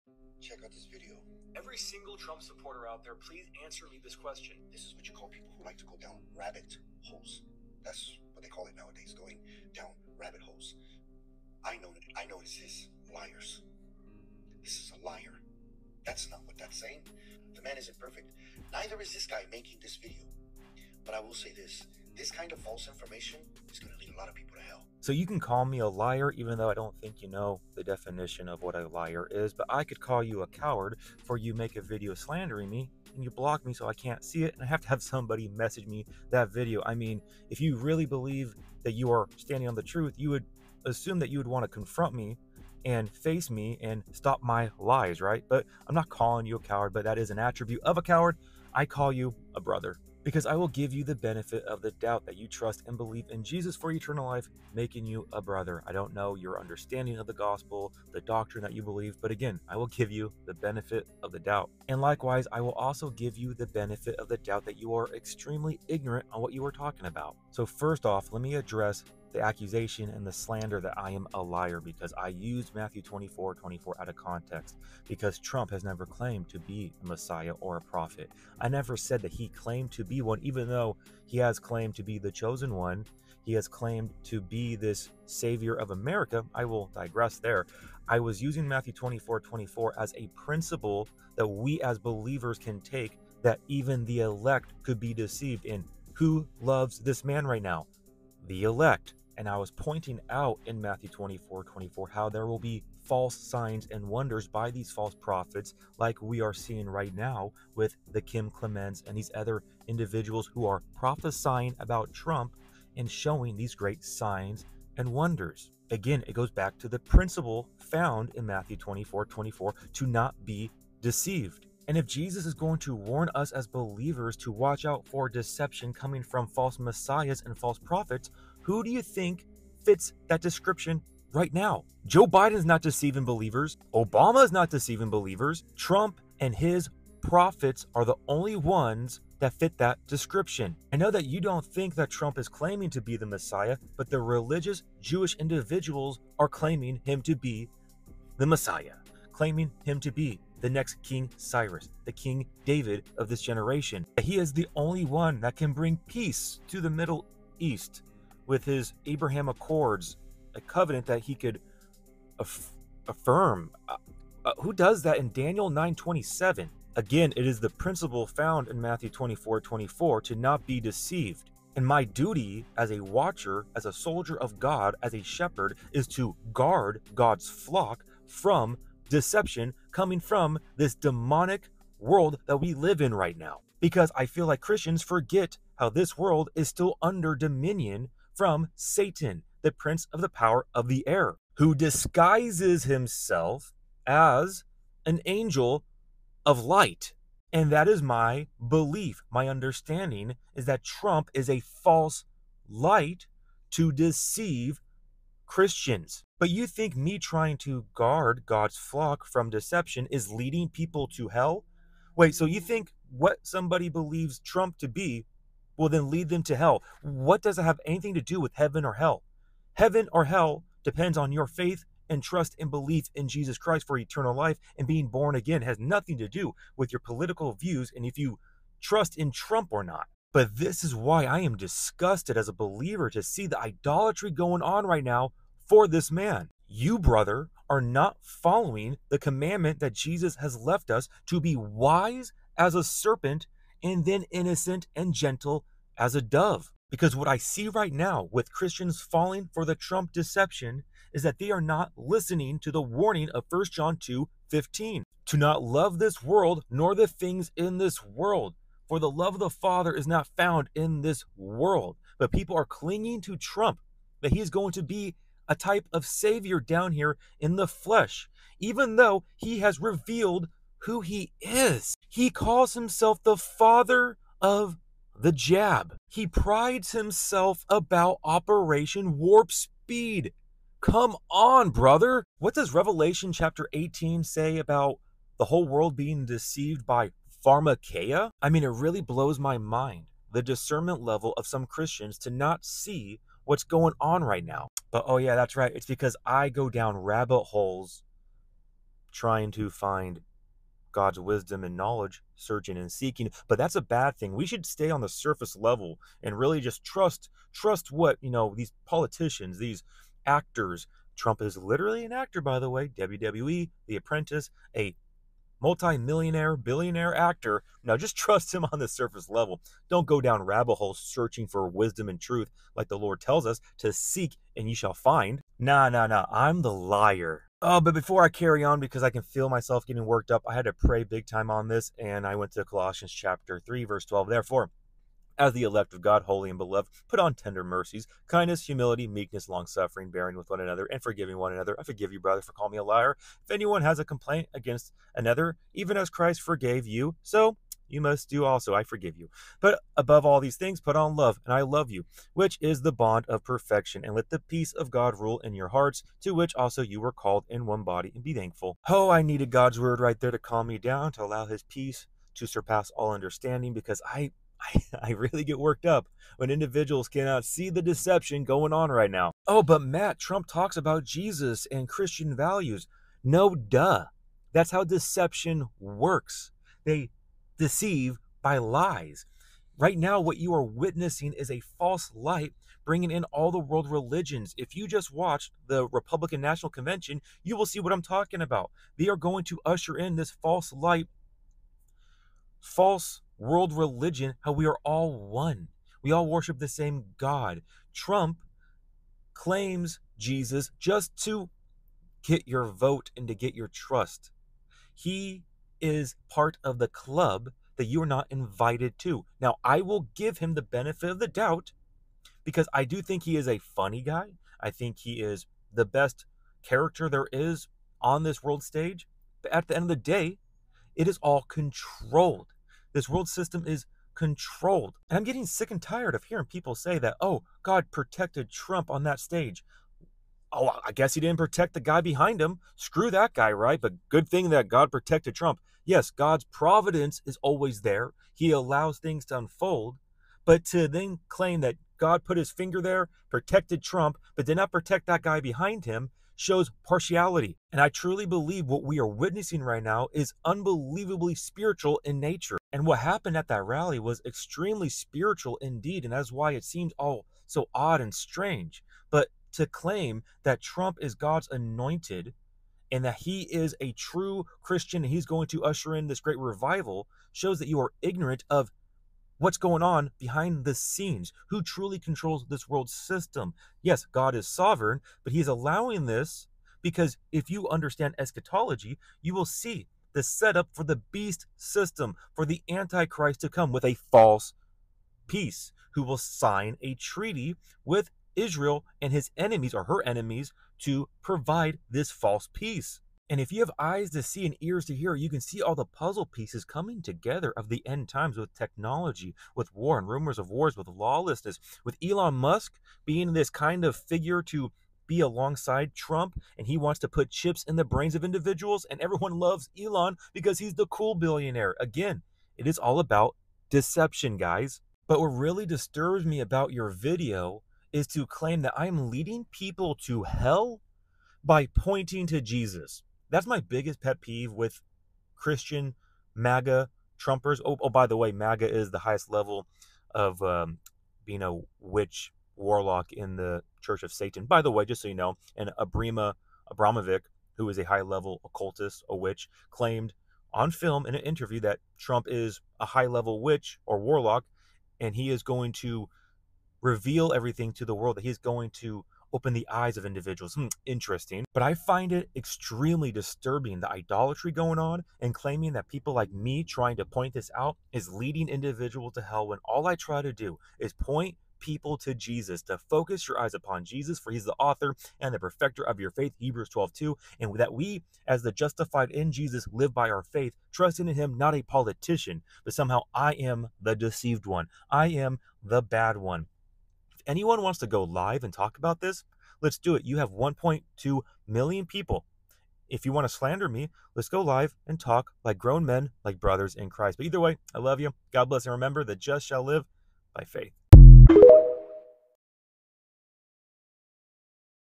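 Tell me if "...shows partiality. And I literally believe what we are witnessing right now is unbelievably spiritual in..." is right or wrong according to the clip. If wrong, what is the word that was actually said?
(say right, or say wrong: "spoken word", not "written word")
wrong: "truly", not "literally".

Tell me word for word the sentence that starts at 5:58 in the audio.
Oh, I needed God's word right there to calm me down, to allow his peace to surpass all understanding, because I.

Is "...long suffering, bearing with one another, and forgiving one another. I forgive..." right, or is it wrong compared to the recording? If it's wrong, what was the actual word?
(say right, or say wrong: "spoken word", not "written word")
right.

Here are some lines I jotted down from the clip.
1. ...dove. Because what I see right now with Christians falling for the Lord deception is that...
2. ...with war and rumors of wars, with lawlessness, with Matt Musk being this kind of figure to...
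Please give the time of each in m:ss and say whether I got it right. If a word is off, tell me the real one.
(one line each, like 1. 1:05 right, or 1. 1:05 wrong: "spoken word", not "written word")
1. 4:06 wrong: "Trump", not "Lord"
2. 8:19 wrong: "Elon", not "Matt".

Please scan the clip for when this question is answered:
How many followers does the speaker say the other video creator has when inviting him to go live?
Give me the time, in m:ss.
9:40.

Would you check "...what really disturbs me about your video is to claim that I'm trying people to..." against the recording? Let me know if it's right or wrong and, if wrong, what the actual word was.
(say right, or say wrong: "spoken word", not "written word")
wrong: "leading", not "trying".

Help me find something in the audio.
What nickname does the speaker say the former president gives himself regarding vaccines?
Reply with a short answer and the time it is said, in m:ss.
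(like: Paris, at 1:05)
the father of the jab, at 4:33.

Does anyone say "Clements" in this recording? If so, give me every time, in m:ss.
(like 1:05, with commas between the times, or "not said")
1:48.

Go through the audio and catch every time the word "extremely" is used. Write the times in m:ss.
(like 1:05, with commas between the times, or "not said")
1:05, 7:34, 9:12.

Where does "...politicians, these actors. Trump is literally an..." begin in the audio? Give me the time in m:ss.
5:08.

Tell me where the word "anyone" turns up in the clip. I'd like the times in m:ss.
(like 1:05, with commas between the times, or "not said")
5:43, 9:37.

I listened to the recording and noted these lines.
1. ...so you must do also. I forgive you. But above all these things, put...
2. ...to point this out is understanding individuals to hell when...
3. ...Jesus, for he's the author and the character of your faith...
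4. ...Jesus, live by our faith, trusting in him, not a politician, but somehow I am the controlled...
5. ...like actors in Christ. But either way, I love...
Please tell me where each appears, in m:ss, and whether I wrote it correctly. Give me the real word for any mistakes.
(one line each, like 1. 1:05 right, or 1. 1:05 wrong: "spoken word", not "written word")
1. 5:47 right
2. 9:16 wrong: "leading", not "understanding"
3. 9:23 wrong: "perfecter", not "character"
4. 9:29 wrong: "deceived", not "controlled"
5. 9:46 wrong: "brothers", not "actors".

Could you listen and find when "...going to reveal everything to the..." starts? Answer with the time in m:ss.
9:05.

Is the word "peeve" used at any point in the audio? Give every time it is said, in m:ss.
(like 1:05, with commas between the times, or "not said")
8:44.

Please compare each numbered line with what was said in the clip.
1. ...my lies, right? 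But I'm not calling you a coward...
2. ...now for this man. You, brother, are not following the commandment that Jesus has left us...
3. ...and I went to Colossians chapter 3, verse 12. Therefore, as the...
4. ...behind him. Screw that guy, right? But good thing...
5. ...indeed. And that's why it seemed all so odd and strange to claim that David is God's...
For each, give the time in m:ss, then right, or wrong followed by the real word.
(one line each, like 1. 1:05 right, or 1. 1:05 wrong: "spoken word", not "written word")
1. 0:44 right
2. 3:55 right
3. 5:31 right
4. 7:12 right
5. 7:35 wrong: "Trump", not "David".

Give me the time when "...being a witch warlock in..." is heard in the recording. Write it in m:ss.
8:51.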